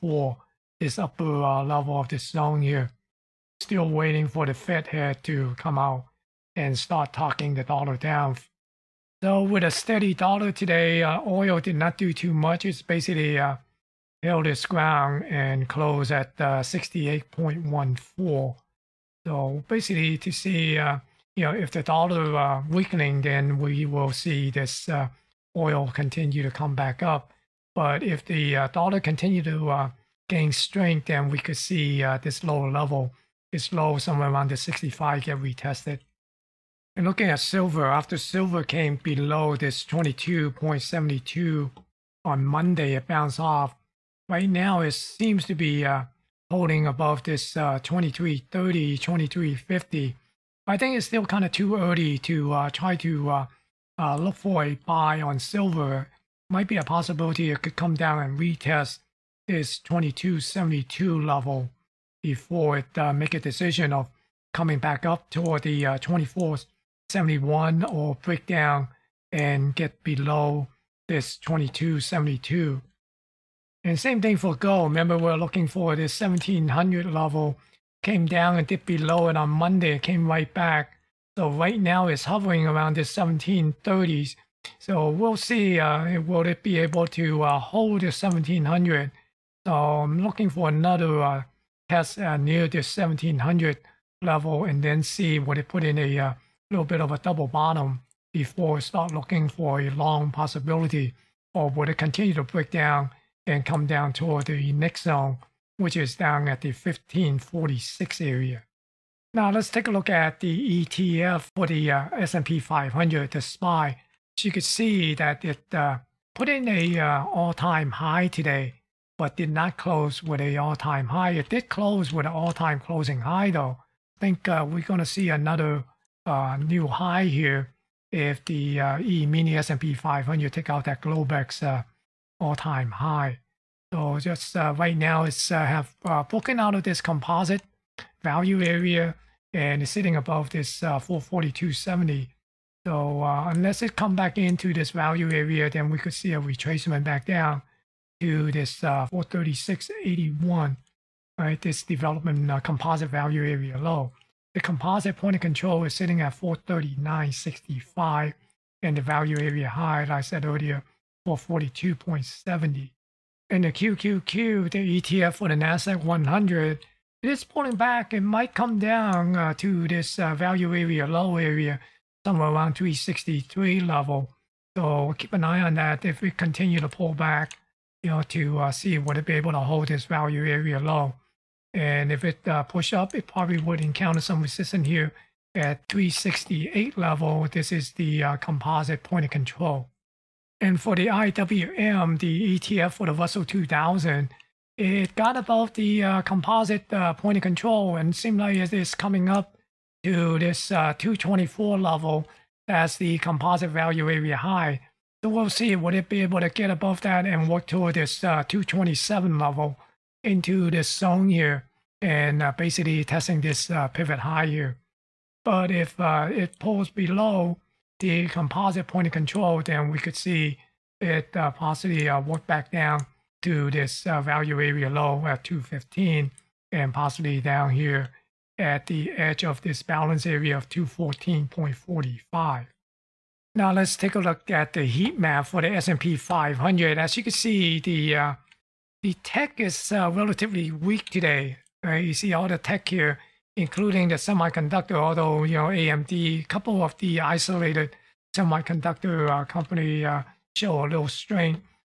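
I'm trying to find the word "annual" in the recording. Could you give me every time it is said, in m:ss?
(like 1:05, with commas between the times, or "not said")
not said.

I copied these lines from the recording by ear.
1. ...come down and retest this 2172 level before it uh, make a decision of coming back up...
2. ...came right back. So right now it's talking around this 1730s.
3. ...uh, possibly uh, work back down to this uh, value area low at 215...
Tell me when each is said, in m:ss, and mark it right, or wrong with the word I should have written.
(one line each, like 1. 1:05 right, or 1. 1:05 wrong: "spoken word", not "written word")
1. 0:57 wrong: "2272", not "2172"
2. 1:20 wrong: "hovering", not "talking"
3. 3:41 right.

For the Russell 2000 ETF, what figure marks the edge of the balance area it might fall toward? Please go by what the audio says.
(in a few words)
214.45.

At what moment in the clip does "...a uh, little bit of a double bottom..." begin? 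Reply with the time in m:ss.
1:35.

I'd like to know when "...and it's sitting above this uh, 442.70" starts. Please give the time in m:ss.
2:19.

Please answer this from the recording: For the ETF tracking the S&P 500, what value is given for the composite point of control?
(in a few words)
439.65.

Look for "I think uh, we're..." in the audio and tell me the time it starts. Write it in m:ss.
2:04.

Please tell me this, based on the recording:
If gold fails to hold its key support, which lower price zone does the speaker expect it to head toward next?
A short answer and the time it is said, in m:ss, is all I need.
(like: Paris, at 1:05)
1546, at 1:46.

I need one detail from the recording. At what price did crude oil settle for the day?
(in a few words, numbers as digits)
68.14.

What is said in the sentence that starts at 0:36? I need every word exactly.
And looking at silver, after silver came below this 22.72 on Monday, it bounced off.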